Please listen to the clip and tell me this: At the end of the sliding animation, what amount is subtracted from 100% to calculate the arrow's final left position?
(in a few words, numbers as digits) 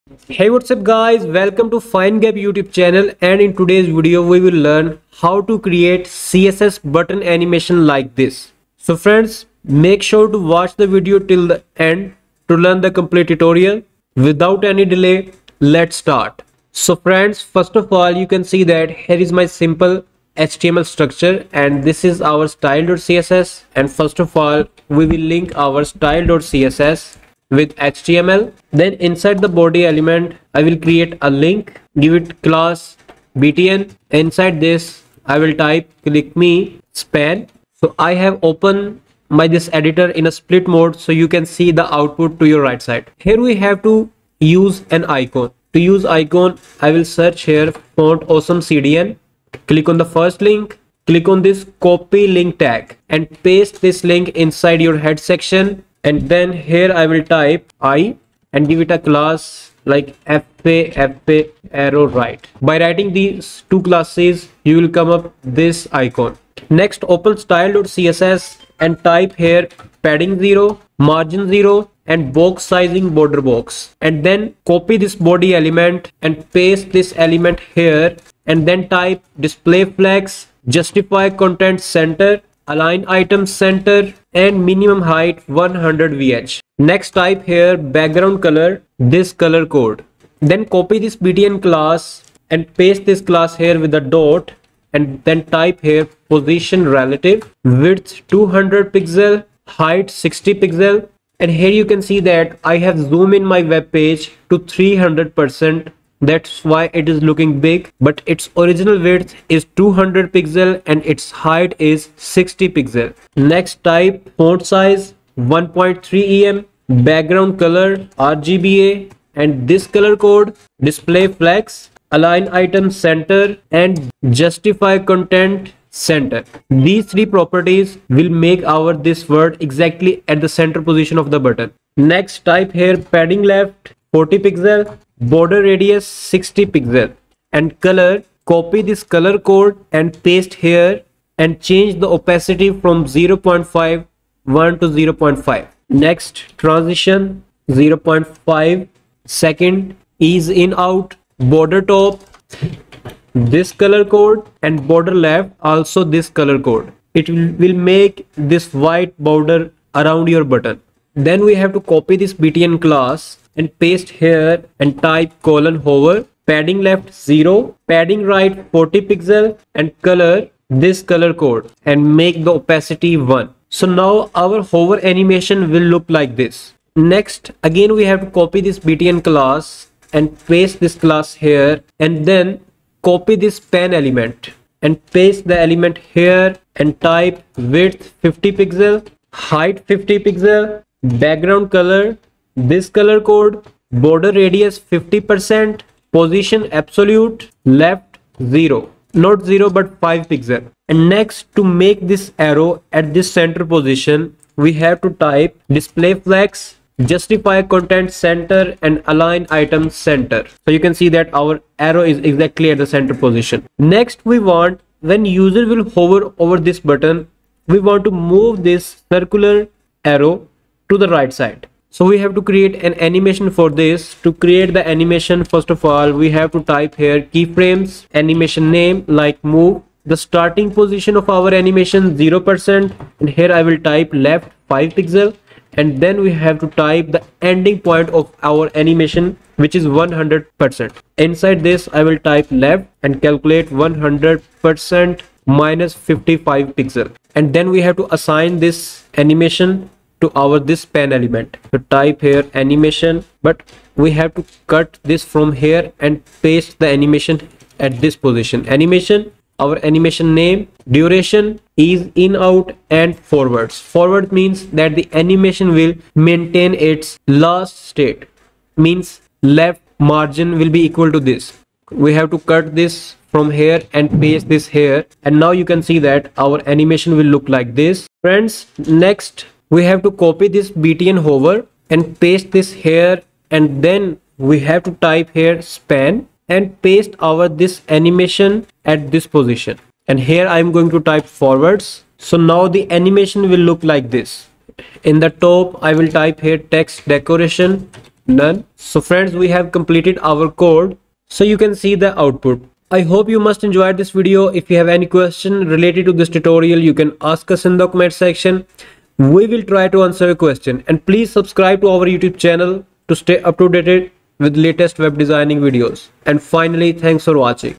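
55 pixel.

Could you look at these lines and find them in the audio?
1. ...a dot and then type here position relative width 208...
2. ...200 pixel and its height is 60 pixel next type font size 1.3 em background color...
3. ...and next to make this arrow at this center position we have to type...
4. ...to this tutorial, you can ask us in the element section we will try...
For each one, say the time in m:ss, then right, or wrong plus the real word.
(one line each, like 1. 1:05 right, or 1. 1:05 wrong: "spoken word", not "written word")
1. 1:33 wrong: "200", not "208"
2. 1:49 right
3. 3:20 right
4. 5:06 wrong: "comment", not "element".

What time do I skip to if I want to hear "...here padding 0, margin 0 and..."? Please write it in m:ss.
1:09.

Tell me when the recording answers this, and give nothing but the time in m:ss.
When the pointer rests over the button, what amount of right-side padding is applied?
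2:47.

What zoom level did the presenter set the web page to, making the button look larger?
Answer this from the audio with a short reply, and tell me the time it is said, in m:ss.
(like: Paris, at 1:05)
300 percent, at 1:44.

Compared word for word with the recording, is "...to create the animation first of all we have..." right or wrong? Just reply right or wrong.
right.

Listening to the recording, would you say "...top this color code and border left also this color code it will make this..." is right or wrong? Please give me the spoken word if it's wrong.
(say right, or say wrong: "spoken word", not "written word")
right.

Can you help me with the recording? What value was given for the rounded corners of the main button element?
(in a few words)
60 pixel.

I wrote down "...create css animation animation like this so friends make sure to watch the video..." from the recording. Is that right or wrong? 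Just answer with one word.
wrong.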